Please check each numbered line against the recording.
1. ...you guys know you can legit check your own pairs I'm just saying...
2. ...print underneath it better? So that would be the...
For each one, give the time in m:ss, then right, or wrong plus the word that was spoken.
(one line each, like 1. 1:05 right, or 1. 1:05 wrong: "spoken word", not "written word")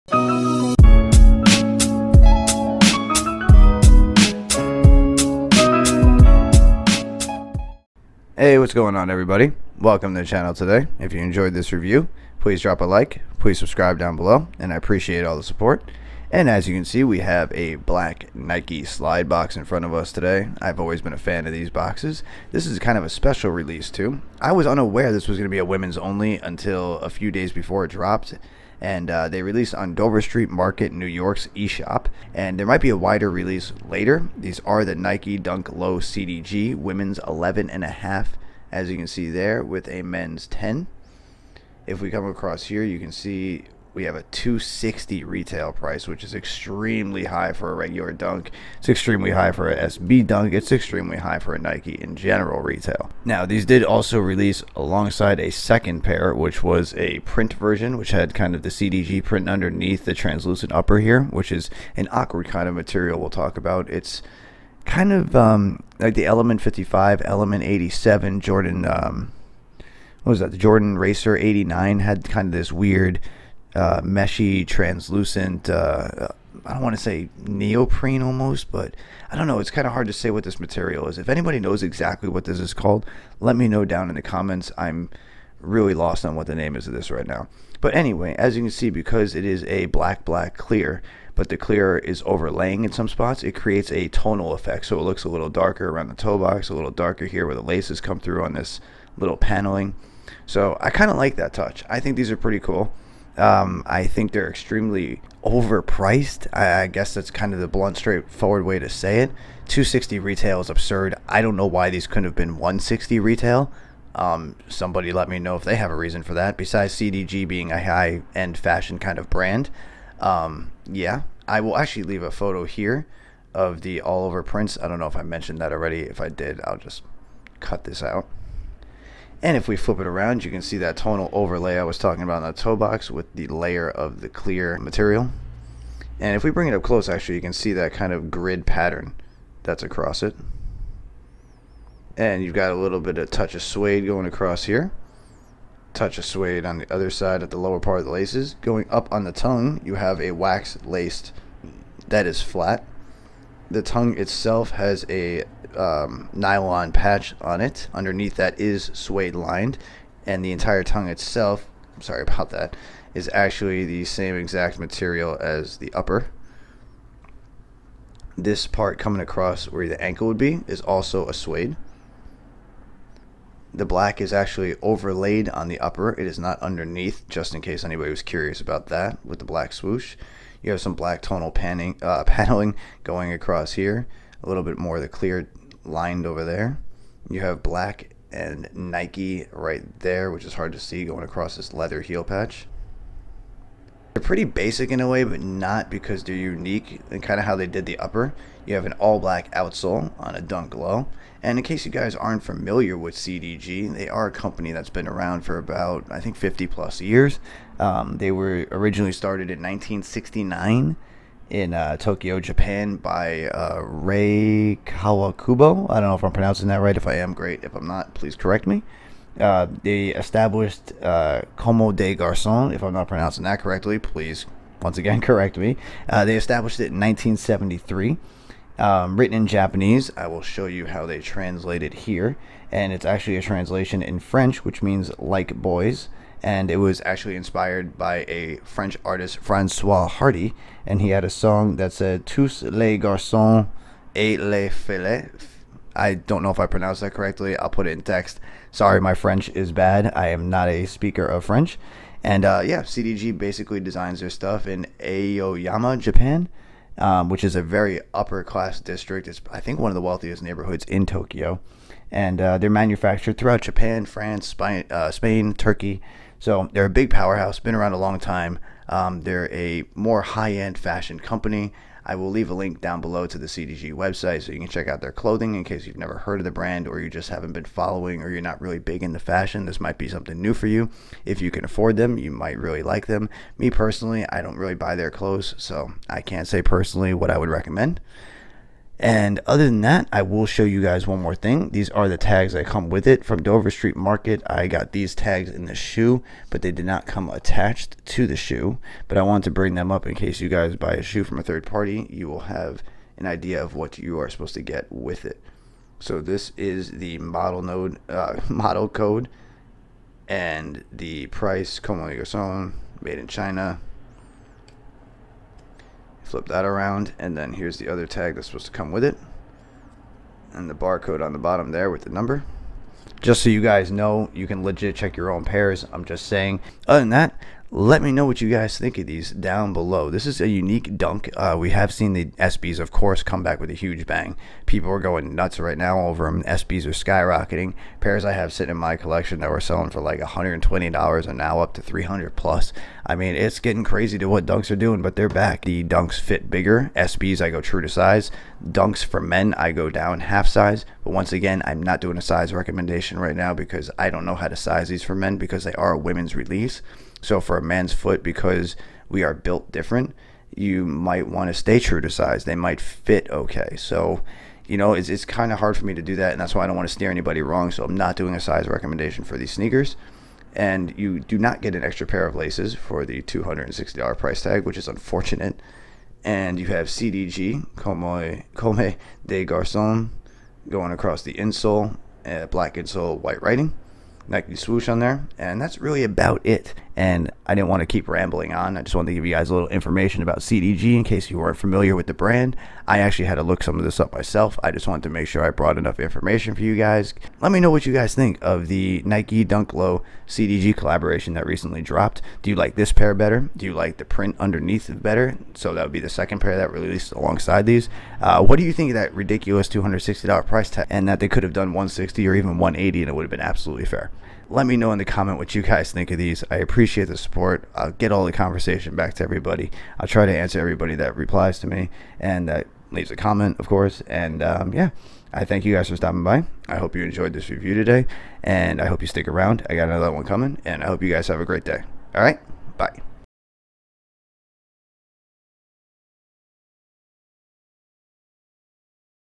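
1. 5:23 right
2. 6:44 right.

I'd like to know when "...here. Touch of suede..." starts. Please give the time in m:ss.
2:24.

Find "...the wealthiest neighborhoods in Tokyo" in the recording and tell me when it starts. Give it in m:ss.
4:19.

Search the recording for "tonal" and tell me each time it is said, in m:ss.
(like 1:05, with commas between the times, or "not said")
1:34, 2:10, 3:01.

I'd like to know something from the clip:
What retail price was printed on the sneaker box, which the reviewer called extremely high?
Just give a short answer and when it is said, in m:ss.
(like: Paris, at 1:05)
$260, at 0:44.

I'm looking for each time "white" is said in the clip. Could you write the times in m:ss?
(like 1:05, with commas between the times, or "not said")
6:23.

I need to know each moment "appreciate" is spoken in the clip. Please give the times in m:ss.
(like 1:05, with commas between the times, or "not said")
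0:14, 6:56.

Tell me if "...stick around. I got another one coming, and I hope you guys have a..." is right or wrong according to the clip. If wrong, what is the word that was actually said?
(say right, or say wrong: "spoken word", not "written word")
right.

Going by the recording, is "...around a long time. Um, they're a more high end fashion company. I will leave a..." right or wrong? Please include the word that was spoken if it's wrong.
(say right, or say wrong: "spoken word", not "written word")
right.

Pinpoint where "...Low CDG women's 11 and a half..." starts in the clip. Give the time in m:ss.
0:35.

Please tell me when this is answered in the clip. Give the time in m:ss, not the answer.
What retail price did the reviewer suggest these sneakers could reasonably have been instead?
1:52.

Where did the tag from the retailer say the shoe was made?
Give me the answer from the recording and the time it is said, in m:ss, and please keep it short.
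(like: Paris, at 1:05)
China, at 5:13.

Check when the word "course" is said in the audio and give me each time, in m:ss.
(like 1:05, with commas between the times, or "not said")
5:32, 7:03.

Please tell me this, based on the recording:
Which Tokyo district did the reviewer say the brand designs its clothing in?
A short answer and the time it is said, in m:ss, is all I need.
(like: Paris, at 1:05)
Aoyama, at 4:15.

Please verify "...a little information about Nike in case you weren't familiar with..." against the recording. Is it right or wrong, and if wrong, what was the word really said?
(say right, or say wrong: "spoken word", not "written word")
wrong: "CDG", not "Nike".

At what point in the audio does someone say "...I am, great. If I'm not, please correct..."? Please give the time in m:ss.
3:37.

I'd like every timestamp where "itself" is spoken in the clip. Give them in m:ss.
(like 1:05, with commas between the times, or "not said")
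2:34, 2:41.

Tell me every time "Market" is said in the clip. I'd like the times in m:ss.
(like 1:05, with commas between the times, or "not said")
0:30, 4:53.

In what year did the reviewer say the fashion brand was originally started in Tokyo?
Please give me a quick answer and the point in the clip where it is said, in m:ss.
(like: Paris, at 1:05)
1969, at 3:29.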